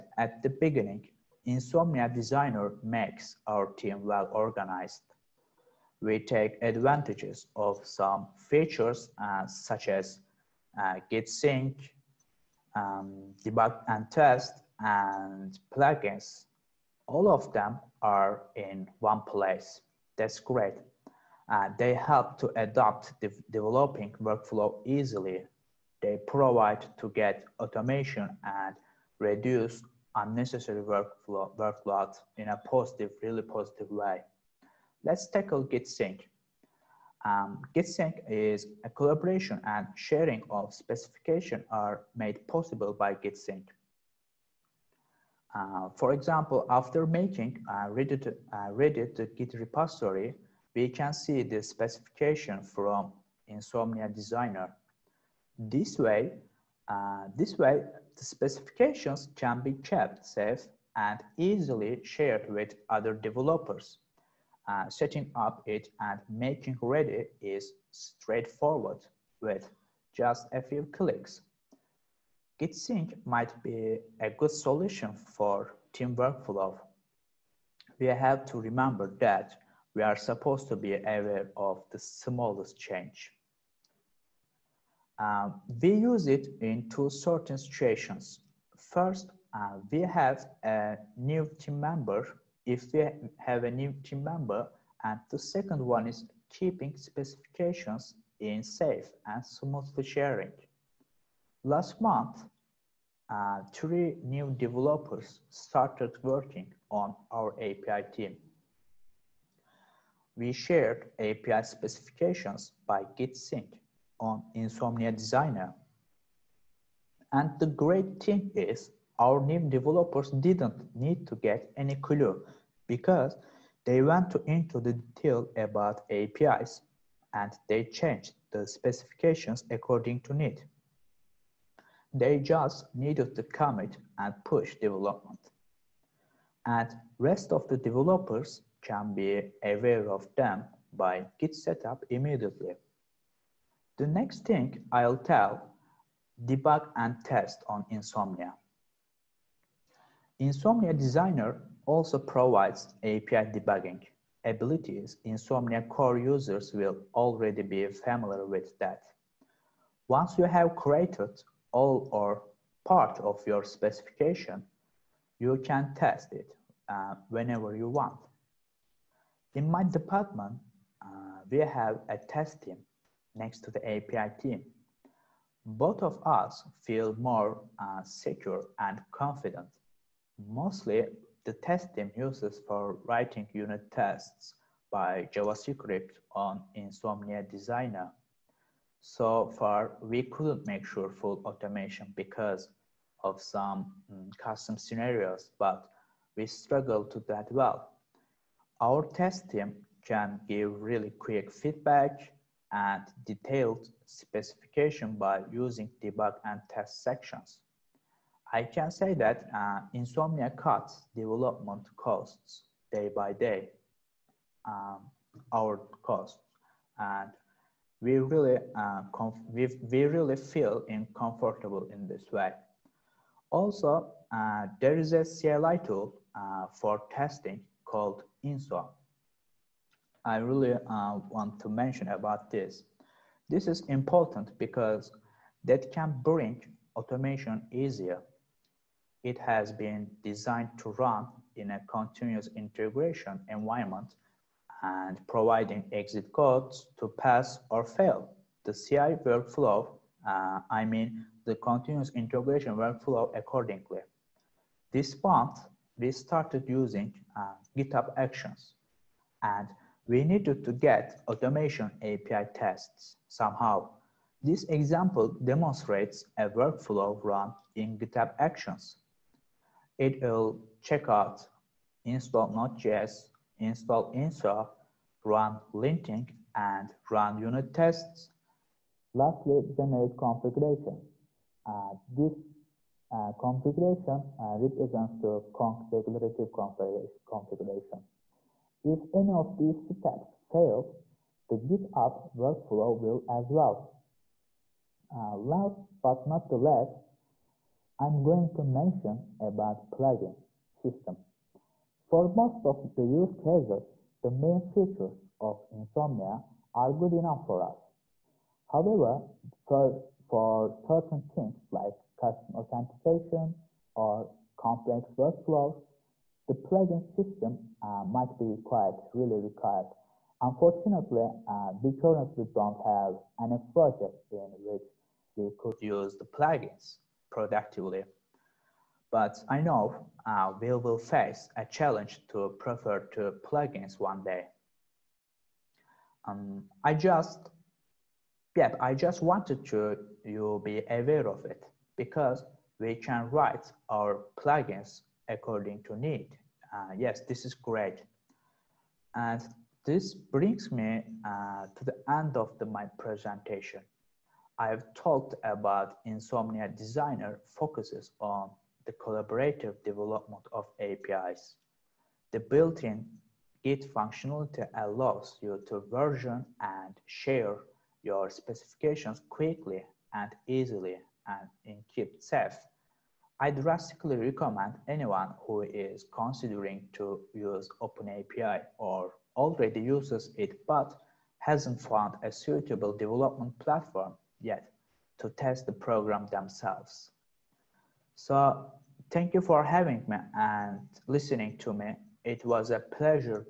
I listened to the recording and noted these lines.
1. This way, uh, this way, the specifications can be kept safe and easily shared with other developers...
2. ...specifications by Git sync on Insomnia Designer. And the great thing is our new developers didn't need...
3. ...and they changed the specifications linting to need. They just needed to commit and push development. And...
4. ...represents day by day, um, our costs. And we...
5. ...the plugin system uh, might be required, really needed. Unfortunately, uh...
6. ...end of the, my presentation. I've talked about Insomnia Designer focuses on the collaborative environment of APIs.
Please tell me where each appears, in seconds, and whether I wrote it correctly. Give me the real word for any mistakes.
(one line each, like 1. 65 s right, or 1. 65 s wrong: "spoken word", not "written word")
1. 55 s right
2. 111 s right
3. 127 s wrong: "according", not "linting"
4. 211 s wrong: "costs", not "represents"
5. 316 s wrong: "required", not "needed"
6. 352 s wrong: "development", not "environment".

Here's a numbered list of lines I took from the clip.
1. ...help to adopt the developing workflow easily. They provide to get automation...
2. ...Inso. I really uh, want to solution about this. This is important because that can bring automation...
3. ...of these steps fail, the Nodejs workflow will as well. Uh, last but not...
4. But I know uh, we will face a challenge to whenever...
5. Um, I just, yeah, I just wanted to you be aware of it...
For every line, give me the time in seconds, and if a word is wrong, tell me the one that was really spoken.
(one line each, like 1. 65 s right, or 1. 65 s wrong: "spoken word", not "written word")
1. 21 s right
2. 228 s wrong: "mention", not "solution"
3. 289 s wrong: "GitHub", not "Nodejs"
4. 329 s wrong: "prefer", not "whenever"
5. 336 s right.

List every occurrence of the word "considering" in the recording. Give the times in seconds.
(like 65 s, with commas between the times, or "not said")
376 s.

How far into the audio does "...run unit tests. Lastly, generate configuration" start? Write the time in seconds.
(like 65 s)
277 s.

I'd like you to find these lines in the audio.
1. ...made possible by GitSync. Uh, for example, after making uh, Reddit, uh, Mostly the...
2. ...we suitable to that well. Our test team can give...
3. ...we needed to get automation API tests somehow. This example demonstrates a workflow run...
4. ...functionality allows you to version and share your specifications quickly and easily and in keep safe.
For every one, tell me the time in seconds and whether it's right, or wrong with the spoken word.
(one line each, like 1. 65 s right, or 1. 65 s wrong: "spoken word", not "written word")
1. 42 s wrong: "Reddit", not "Mostly"
2. 196 s wrong: "struggle", not "suitable"
3. 260 s right
4. 363 s right.